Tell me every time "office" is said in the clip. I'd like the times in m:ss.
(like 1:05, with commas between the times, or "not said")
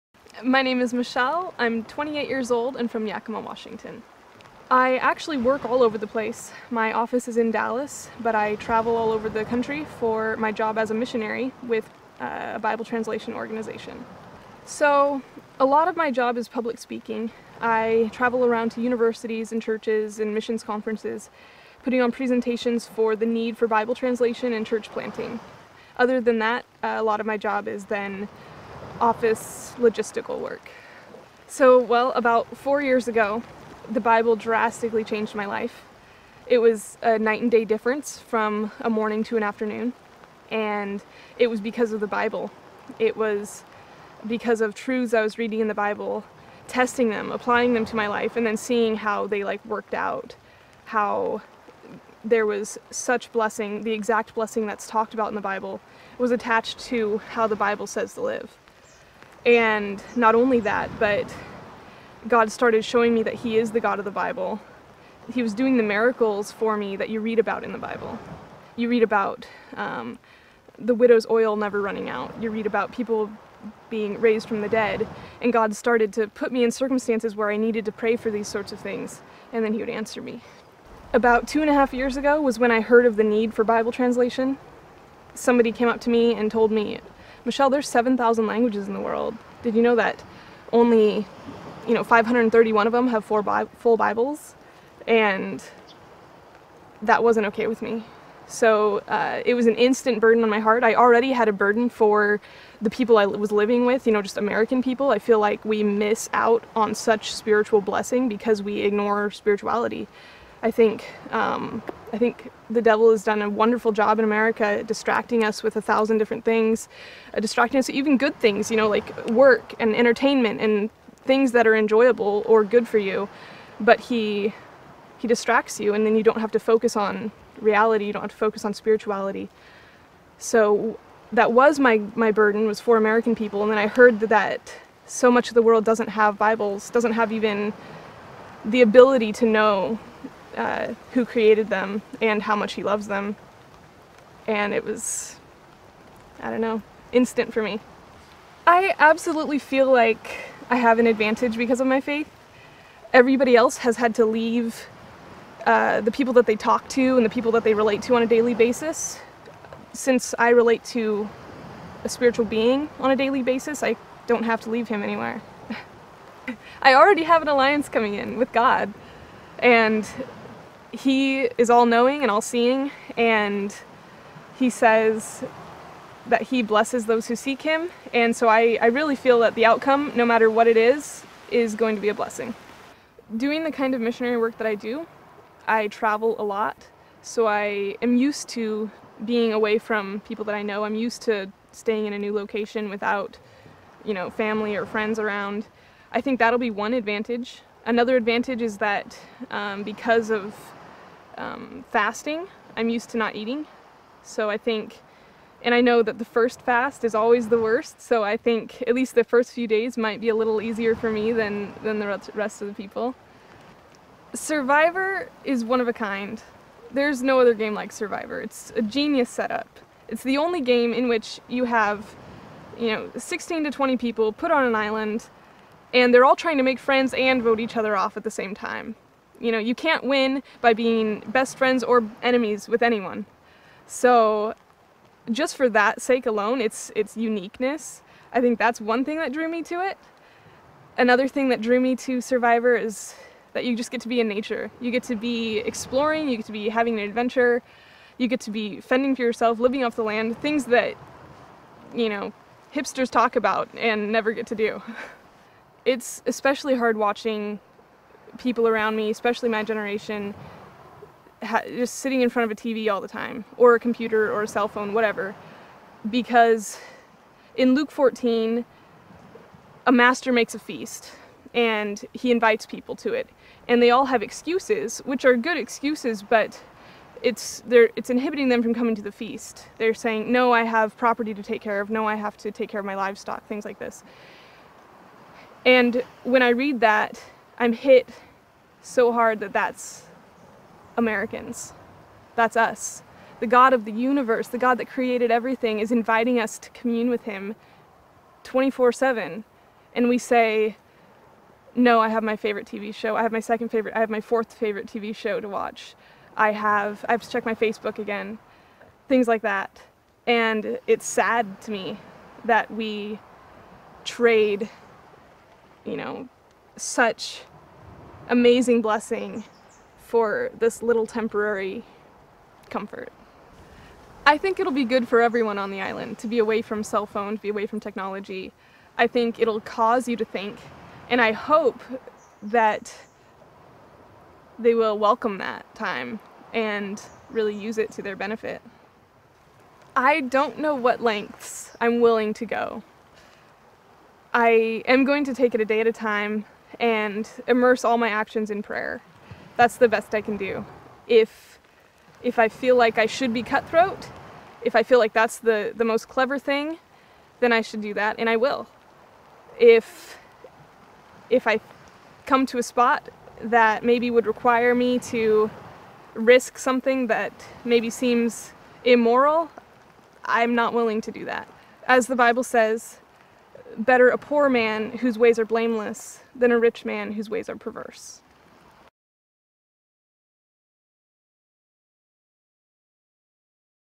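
0:06, 0:29.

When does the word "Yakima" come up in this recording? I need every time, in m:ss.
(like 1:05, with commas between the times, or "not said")
0:03.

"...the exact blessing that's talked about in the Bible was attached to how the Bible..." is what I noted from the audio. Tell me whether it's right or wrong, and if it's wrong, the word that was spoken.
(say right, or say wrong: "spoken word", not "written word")
right.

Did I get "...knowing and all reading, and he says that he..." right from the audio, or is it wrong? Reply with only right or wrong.
wrong.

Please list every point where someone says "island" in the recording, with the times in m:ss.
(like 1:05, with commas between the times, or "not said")
3:44, 5:25.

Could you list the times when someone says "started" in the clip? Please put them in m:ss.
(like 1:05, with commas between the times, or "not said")
1:02, 1:15.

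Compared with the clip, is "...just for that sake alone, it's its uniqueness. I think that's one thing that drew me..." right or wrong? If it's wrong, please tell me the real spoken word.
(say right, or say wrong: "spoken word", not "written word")
right.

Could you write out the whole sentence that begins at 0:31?
So, well, about four years ago, the Bible drastically changed my life.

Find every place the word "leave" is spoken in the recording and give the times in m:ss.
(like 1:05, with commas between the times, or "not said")
2:34, 2:44.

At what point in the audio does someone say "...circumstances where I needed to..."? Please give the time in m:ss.
1:16.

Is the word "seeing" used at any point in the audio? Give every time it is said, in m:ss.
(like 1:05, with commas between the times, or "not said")
0:48, 2:52.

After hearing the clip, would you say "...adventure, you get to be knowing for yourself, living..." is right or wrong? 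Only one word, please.
wrong.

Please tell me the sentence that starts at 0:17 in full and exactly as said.
I travel around to universities and churches and missions conferences, putting on presentations for the need for Bible translation and church planting.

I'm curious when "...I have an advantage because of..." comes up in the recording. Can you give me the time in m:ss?
2:30.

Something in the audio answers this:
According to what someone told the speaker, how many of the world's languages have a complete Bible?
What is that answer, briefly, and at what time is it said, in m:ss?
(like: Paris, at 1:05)
531, at 1:32.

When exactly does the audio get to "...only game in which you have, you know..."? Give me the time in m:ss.
3:40.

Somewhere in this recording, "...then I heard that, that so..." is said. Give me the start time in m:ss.
2:13.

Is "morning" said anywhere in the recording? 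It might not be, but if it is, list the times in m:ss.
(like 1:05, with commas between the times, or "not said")
0:38.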